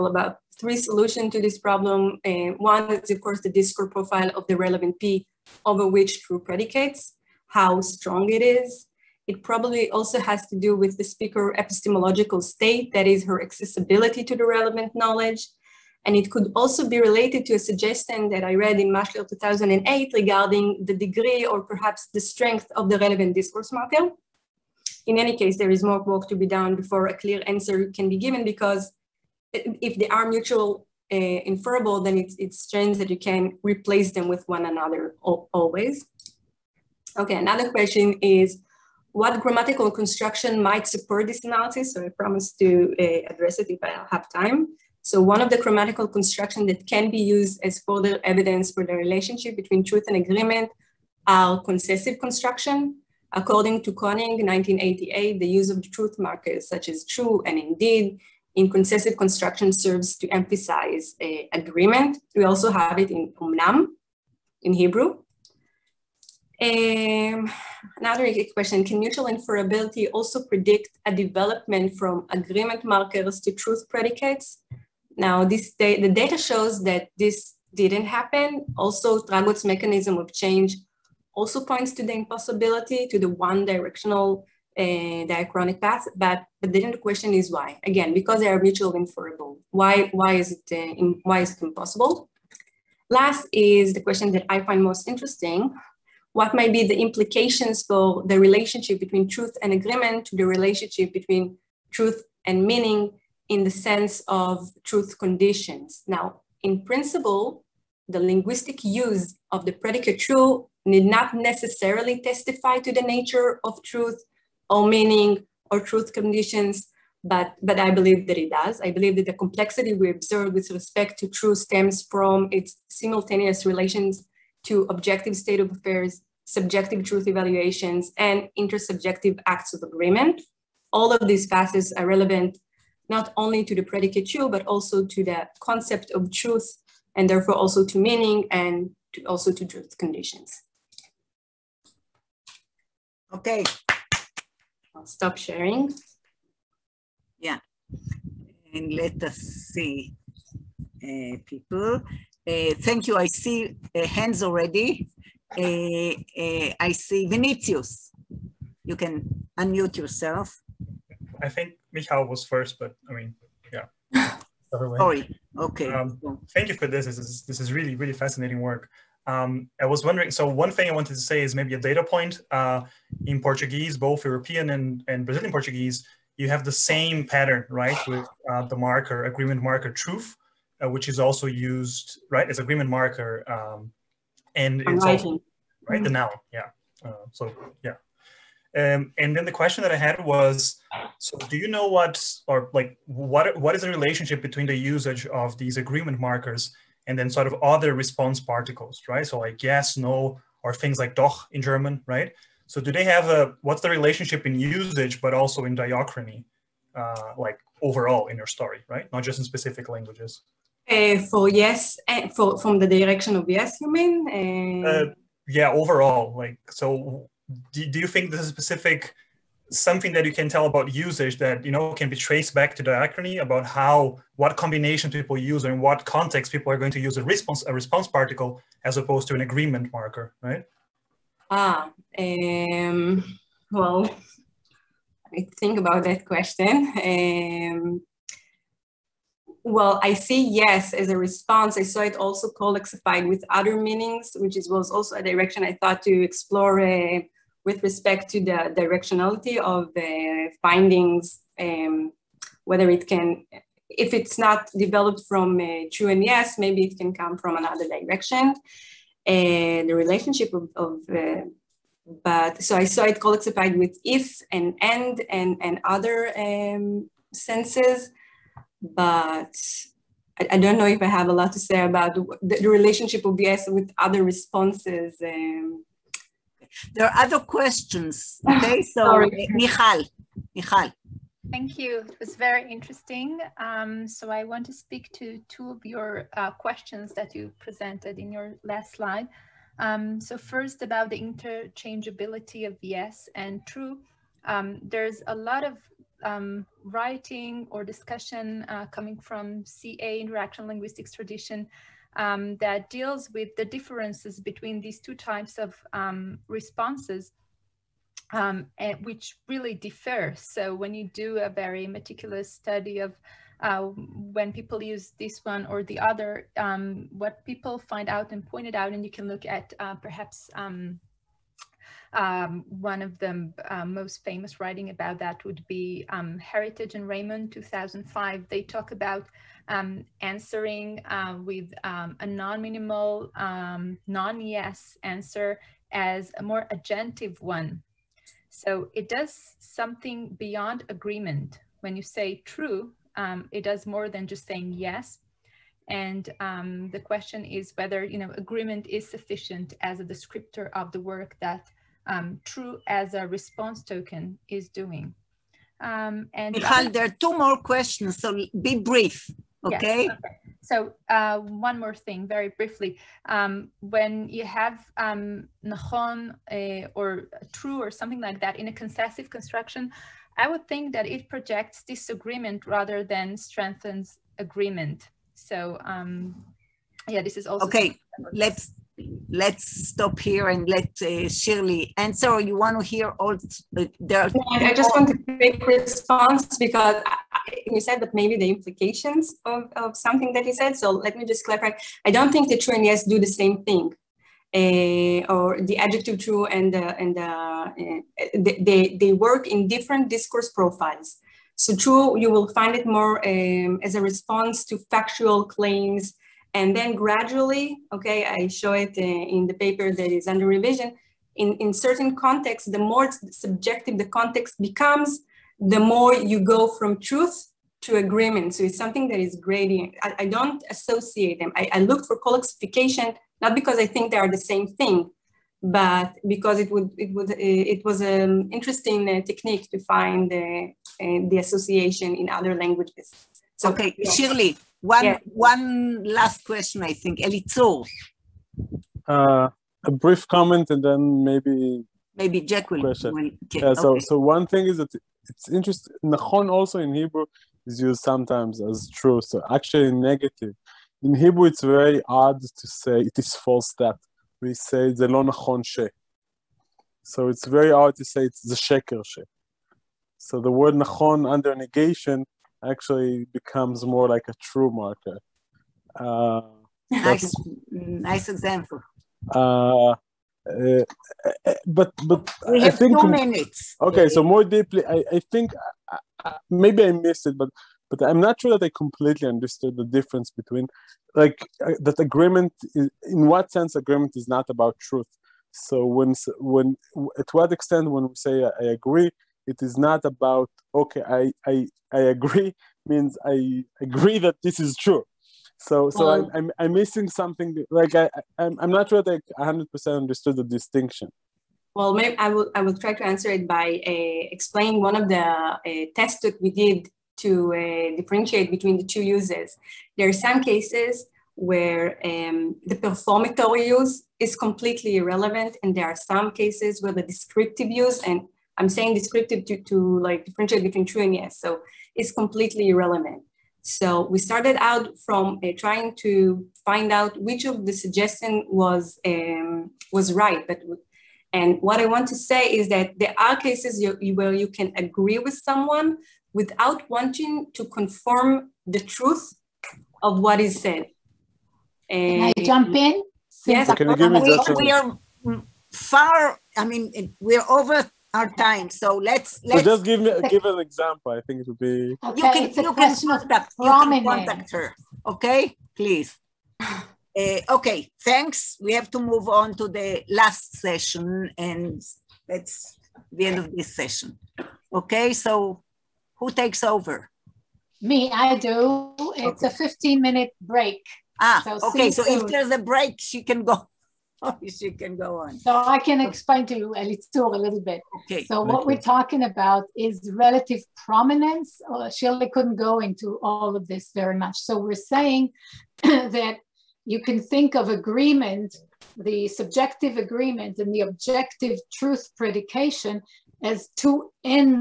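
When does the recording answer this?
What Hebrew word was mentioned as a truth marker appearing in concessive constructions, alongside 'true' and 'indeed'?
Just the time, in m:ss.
1:03.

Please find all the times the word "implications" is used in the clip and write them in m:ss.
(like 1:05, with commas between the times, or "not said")
1:36, 6:28.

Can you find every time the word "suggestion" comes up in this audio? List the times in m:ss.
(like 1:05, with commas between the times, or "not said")
0:17, 8:47.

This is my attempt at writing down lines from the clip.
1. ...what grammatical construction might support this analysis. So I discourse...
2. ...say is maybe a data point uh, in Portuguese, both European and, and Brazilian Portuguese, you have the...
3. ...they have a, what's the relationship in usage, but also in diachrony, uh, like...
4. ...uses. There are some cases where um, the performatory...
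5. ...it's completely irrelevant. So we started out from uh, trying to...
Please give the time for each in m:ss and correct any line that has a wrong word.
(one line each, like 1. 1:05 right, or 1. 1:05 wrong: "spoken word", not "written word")
1. 0:39 wrong: "promise", not "discourse"
2. 2:51 right
3. 3:22 right
4. 8:29 right
5. 8:41 right.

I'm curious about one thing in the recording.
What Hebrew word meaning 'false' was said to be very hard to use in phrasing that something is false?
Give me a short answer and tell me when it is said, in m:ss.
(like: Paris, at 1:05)
sheker, at 7:38.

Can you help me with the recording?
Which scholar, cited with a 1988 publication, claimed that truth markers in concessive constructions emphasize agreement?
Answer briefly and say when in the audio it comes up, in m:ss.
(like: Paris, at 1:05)
König, at 0:53.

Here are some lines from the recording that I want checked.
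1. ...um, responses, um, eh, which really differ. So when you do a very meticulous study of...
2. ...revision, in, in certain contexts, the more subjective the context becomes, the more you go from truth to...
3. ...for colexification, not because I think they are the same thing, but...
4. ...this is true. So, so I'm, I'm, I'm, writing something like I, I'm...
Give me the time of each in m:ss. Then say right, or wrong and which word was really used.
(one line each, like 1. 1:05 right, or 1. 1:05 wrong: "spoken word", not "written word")
1. 5:05 right
2. 6:50 right
3. 7:02 right
4. 8:14 wrong: "missing", not "writing".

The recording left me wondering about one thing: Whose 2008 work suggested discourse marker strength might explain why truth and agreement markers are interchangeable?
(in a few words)
Maschler.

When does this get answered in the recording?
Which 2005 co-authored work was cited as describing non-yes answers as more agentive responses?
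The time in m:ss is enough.
5:26.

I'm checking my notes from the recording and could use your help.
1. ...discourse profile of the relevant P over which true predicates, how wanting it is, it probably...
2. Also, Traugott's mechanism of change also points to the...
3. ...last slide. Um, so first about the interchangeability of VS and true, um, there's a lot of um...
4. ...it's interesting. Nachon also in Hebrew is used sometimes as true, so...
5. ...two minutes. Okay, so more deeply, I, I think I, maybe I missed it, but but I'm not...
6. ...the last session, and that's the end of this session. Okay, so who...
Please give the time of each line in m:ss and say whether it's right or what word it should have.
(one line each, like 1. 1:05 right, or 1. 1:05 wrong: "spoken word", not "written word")
1. 0:03 wrong: "strong", not "wanting"
2. 1:18 right
3. 4:48 right
4. 7:25 right
5. 7:53 right
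6. 9:19 right.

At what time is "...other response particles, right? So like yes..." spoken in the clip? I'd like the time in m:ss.
3:17.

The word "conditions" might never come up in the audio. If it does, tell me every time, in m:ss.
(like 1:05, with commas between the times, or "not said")
1:45, 1:56, 2:19.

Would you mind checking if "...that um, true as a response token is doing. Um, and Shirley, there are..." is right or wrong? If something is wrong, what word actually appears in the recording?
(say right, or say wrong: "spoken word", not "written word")
wrong: "Michal", not "Shirley".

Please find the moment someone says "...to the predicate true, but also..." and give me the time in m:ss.
2:13.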